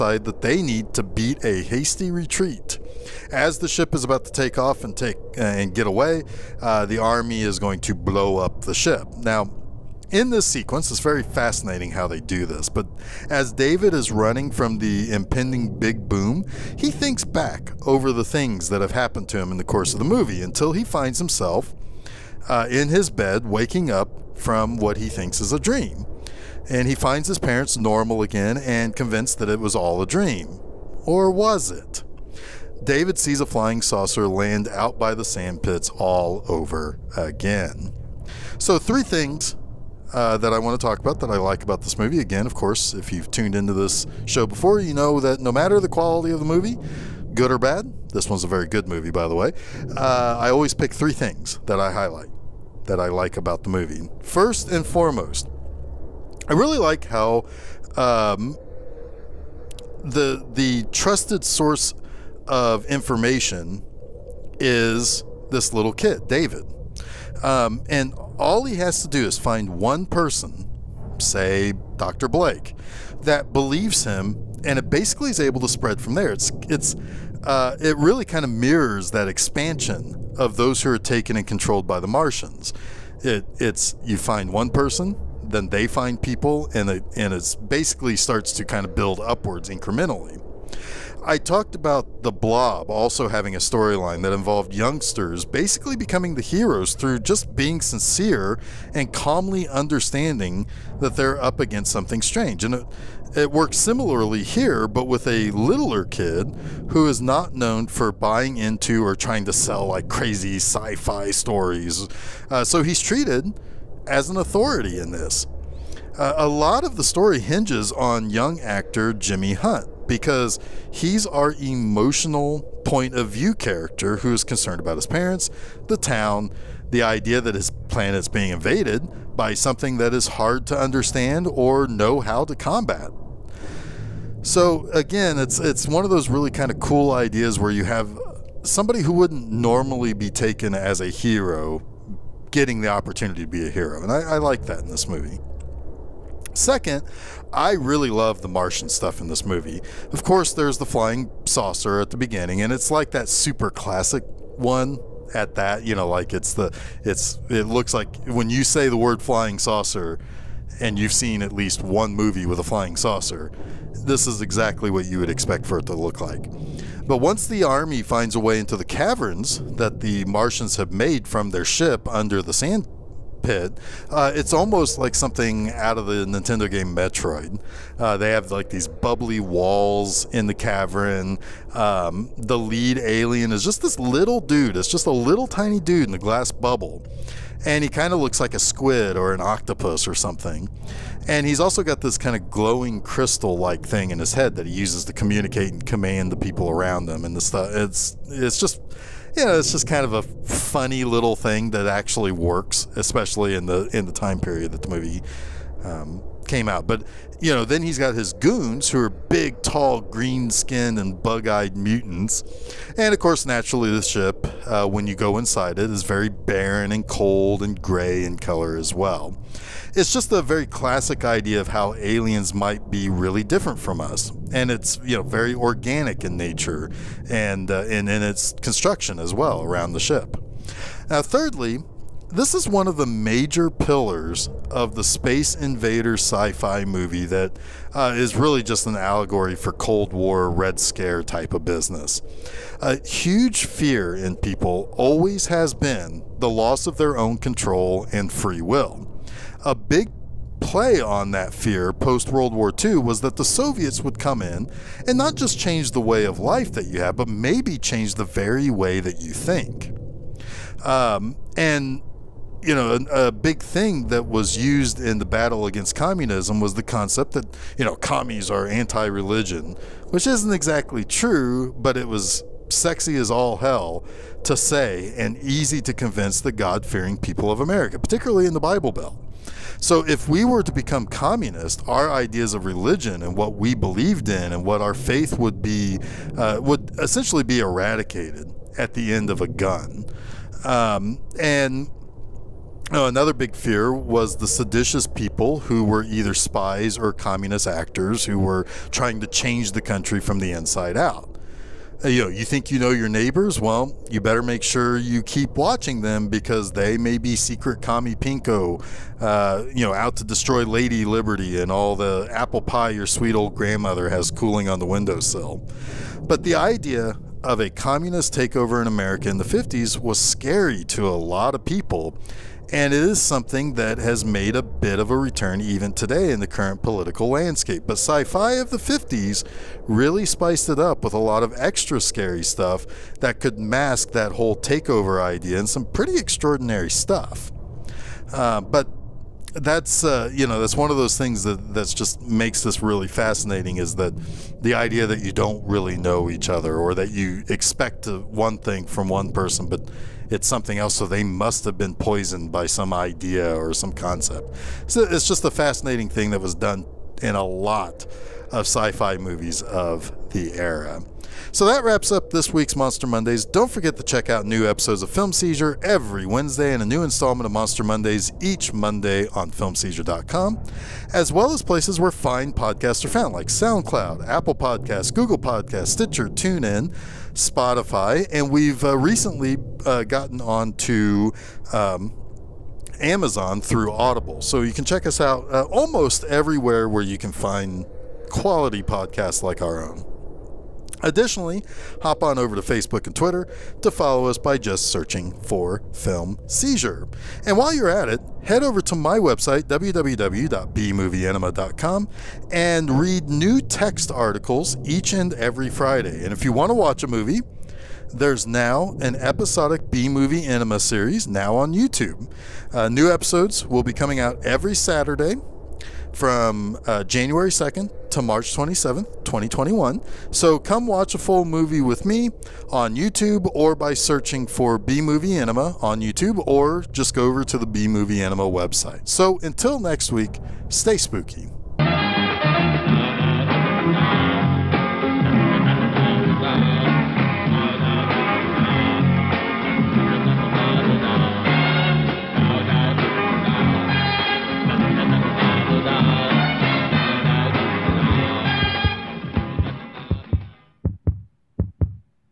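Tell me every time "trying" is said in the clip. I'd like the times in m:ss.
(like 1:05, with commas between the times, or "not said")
1:49, 4:58.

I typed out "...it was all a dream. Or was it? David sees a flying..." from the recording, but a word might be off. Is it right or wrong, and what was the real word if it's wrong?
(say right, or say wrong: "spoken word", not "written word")
right.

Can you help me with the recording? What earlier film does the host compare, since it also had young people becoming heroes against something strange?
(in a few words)
The Blob.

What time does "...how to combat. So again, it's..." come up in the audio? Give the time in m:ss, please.
2:12.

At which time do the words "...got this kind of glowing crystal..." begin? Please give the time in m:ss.
3:11.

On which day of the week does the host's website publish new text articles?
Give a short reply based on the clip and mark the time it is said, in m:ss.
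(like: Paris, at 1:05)
Friday, at 6:45.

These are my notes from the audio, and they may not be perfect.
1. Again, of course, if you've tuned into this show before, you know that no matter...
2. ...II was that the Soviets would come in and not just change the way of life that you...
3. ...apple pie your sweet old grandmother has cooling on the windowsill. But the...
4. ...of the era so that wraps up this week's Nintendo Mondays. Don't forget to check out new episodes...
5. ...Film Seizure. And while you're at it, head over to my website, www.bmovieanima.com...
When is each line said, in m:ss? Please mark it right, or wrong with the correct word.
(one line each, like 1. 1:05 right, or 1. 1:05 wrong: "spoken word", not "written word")
1. 0:42 right
2. 4:12 right
3. 5:12 right
4. 5:59 wrong: "Monster", not "Nintendo"
5. 6:35 right.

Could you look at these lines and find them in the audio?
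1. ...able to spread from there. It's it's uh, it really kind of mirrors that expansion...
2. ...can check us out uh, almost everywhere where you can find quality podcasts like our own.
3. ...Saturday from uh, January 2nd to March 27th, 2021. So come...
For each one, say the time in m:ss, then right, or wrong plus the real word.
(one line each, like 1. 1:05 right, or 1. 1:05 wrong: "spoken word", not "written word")
1. 1:15 right
2. 6:24 right
3. 6:54 right.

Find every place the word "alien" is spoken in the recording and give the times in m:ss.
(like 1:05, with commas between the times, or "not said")
3:02, 3:41.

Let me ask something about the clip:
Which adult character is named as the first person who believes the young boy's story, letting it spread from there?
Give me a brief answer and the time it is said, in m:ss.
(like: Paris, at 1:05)
Dr. Blake, at 1:11.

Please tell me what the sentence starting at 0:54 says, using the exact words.
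First and foremost, I really like how um, the the trusted source of information is this little kid, David.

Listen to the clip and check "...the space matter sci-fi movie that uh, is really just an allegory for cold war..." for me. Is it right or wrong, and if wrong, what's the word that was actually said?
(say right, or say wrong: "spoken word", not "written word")
wrong: "invader", not "matter".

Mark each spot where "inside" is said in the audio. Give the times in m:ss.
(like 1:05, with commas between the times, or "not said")
3:35, 5:00.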